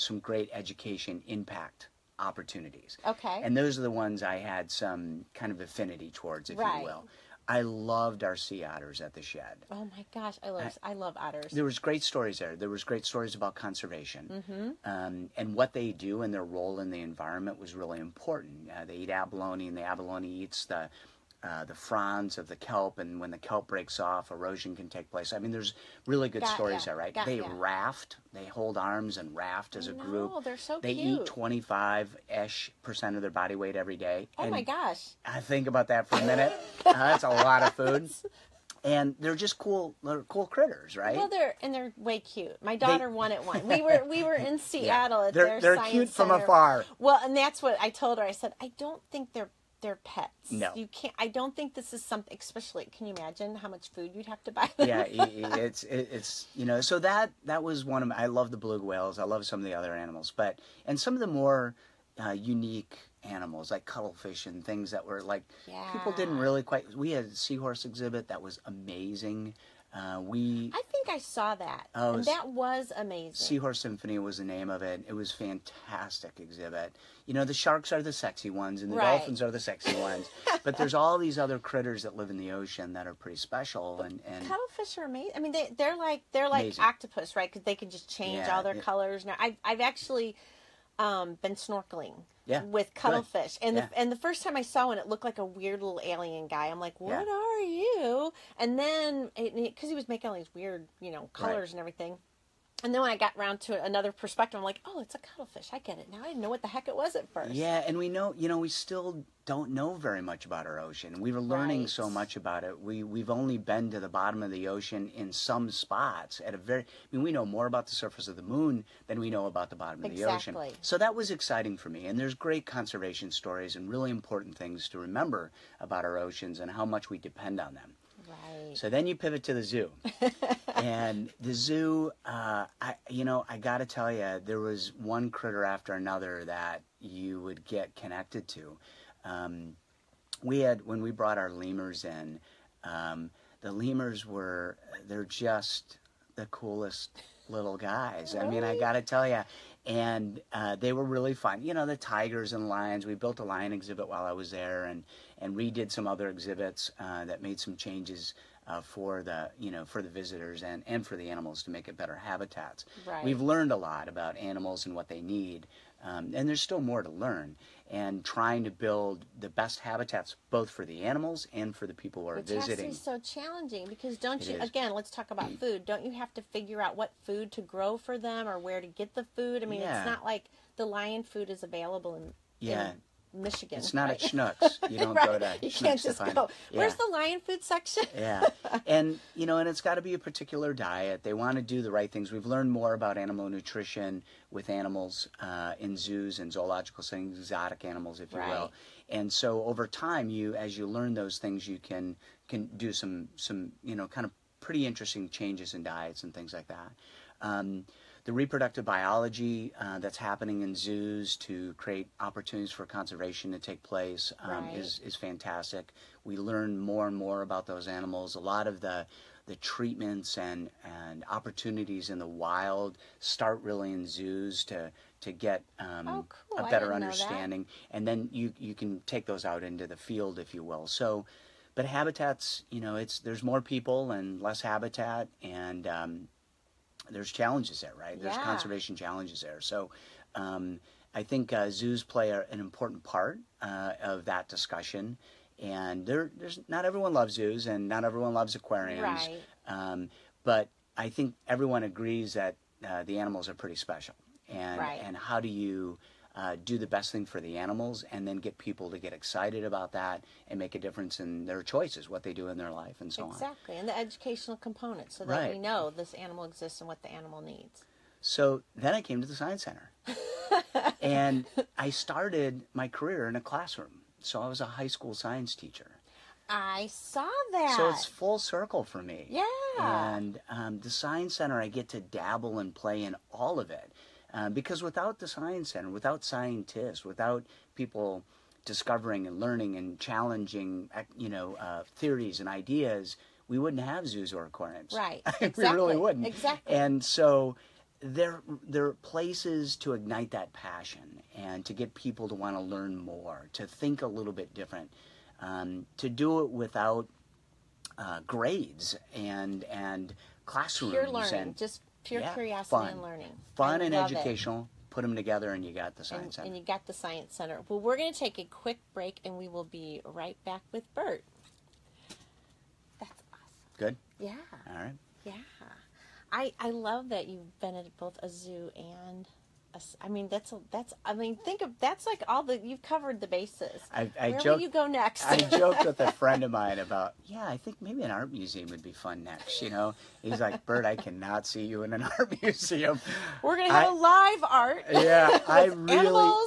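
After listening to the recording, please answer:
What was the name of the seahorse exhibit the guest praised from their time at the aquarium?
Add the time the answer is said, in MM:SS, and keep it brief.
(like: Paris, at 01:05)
Seahorse Symphony, at 01:13.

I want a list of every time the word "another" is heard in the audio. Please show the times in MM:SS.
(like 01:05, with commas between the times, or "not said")
01:43, 02:15.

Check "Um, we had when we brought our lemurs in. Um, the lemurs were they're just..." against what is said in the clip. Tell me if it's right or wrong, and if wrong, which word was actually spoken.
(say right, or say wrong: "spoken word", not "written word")
right.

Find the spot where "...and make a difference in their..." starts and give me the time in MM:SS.
04:20.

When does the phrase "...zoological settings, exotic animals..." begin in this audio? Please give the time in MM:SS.
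03:16.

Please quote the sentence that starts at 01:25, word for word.
I mean, they are like they're like amazing.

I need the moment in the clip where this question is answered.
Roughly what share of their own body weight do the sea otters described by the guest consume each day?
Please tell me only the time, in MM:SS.
00:31.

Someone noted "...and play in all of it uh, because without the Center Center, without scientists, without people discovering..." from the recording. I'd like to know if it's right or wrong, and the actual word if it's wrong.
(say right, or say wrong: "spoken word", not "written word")
wrong: "Science", not "Center".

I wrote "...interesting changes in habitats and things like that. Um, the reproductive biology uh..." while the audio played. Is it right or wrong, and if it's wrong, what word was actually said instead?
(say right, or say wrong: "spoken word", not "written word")
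wrong: "diets", not "habitats".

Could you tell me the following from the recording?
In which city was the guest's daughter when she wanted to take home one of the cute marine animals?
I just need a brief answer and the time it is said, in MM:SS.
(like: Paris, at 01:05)
Seattle, at 00:44.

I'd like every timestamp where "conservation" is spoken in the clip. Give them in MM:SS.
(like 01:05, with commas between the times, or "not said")
00:13, 02:02, 03:32, 03:58.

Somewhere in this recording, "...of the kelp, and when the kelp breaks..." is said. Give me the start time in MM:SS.
00:22.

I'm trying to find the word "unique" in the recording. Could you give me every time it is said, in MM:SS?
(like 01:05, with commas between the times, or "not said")
01:02.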